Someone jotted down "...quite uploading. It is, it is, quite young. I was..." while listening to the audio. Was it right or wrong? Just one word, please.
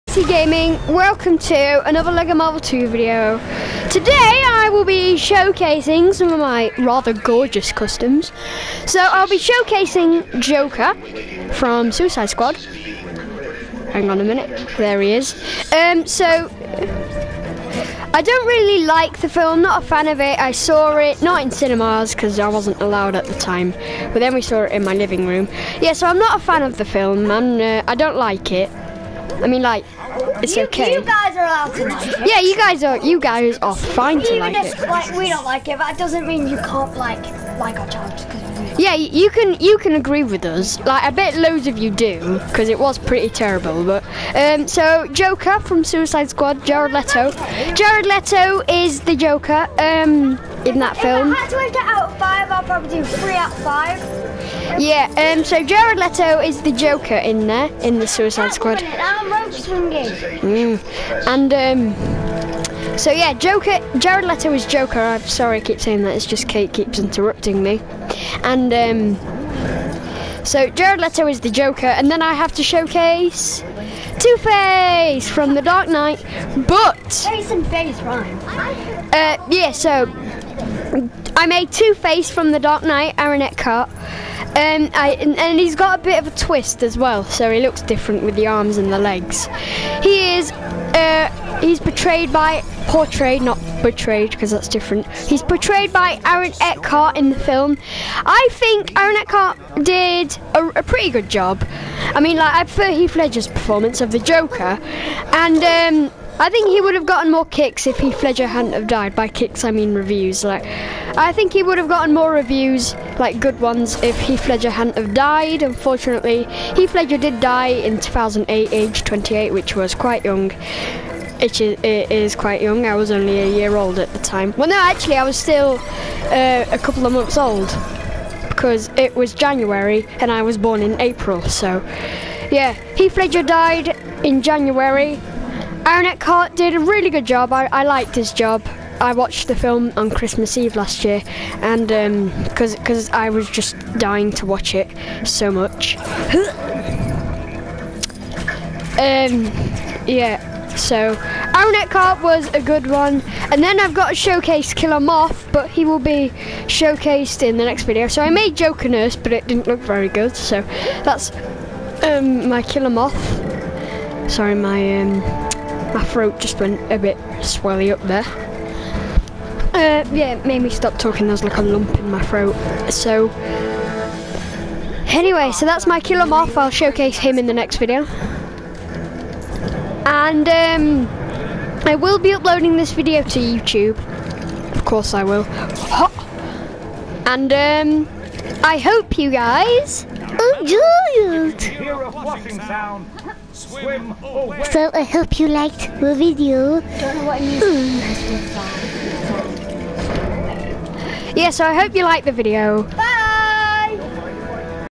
wrong.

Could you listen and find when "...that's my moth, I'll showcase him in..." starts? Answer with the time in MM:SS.
02:55.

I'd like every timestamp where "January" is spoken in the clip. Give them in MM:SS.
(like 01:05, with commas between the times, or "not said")
02:09, 02:14.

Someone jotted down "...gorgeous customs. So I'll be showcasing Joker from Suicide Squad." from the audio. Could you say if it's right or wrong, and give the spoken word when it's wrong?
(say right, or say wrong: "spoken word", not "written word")
right.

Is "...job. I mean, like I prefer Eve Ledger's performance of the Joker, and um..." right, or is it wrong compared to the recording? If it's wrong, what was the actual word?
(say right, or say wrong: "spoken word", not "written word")
wrong: "Heath", not "Eve".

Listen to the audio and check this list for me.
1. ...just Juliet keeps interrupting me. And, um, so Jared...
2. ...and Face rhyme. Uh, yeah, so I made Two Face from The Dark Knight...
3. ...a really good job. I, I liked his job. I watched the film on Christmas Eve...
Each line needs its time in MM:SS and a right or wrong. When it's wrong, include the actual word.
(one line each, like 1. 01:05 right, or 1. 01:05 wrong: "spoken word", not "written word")
1. 01:06 wrong: "Kate", not "Juliet"
2. 01:17 right
3. 02:16 right.